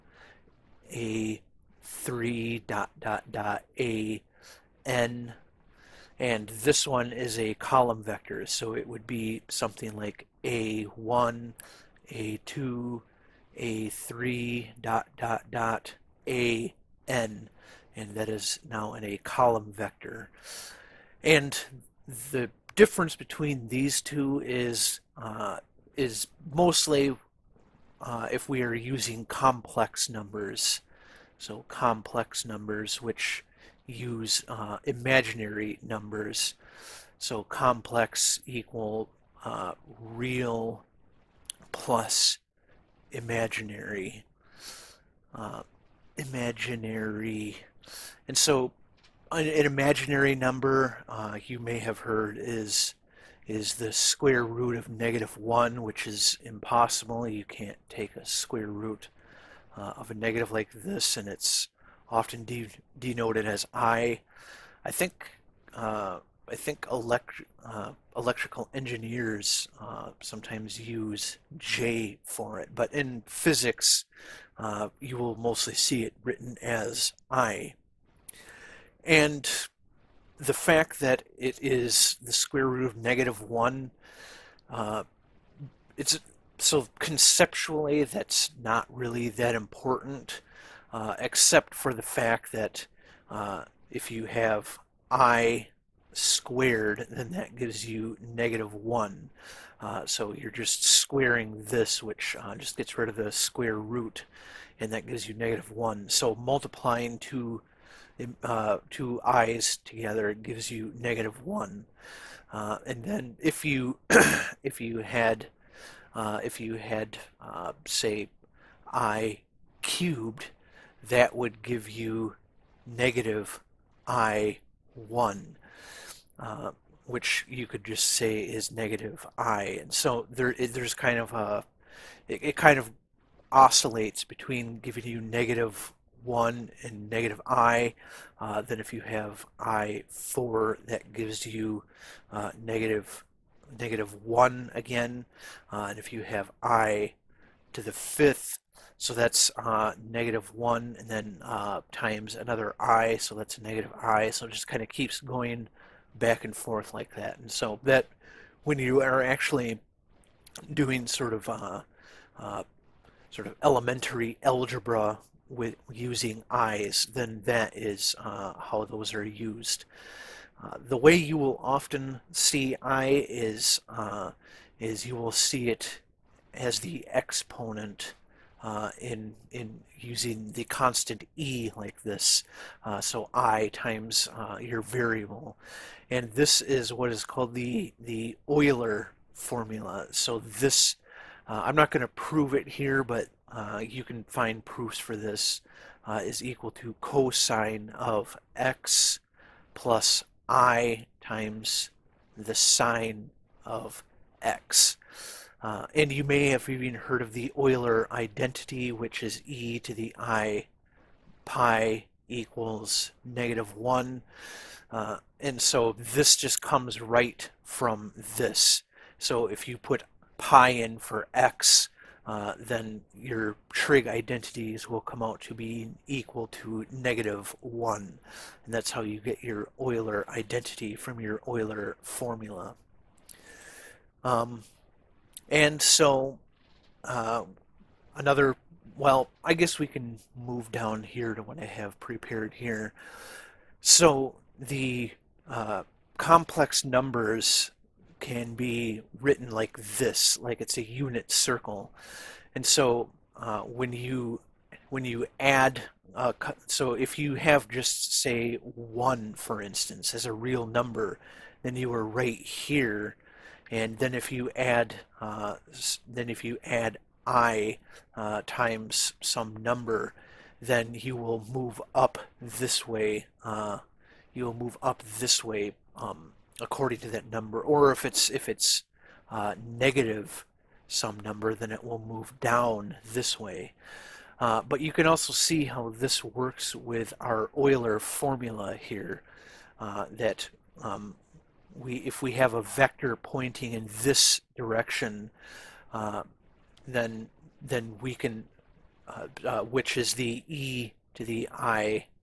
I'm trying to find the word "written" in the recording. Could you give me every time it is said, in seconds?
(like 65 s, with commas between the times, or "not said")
76 s, 249 s.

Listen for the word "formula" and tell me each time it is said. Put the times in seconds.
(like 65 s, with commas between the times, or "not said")
189 s, 232 s, 287 s.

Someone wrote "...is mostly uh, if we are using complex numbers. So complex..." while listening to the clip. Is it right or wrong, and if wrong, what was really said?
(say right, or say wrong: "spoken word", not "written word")
right.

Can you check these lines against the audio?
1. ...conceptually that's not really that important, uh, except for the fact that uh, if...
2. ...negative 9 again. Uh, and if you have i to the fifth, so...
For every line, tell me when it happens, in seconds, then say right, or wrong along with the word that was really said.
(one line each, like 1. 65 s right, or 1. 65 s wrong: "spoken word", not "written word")
1. 86 s right
2. 143 s wrong: "1", not "9".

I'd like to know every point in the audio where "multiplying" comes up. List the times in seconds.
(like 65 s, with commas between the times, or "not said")
106 s.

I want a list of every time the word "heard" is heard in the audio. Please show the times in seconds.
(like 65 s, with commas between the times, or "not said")
51 s, 206 s.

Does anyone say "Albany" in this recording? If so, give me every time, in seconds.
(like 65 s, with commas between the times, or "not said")
not said.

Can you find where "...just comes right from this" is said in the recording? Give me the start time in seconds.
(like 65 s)
216 s.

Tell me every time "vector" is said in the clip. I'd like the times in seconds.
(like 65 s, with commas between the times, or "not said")
8 s, 19 s, 292 s.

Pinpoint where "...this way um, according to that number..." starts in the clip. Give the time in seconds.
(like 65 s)
275 s.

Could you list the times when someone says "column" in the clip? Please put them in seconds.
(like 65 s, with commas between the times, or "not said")
7 s, 19 s.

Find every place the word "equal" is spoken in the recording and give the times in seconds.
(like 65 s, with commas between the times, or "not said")
38 s, 196 s, 212 s, 226 s.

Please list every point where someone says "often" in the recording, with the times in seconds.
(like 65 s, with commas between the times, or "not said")
62 s, 171 s.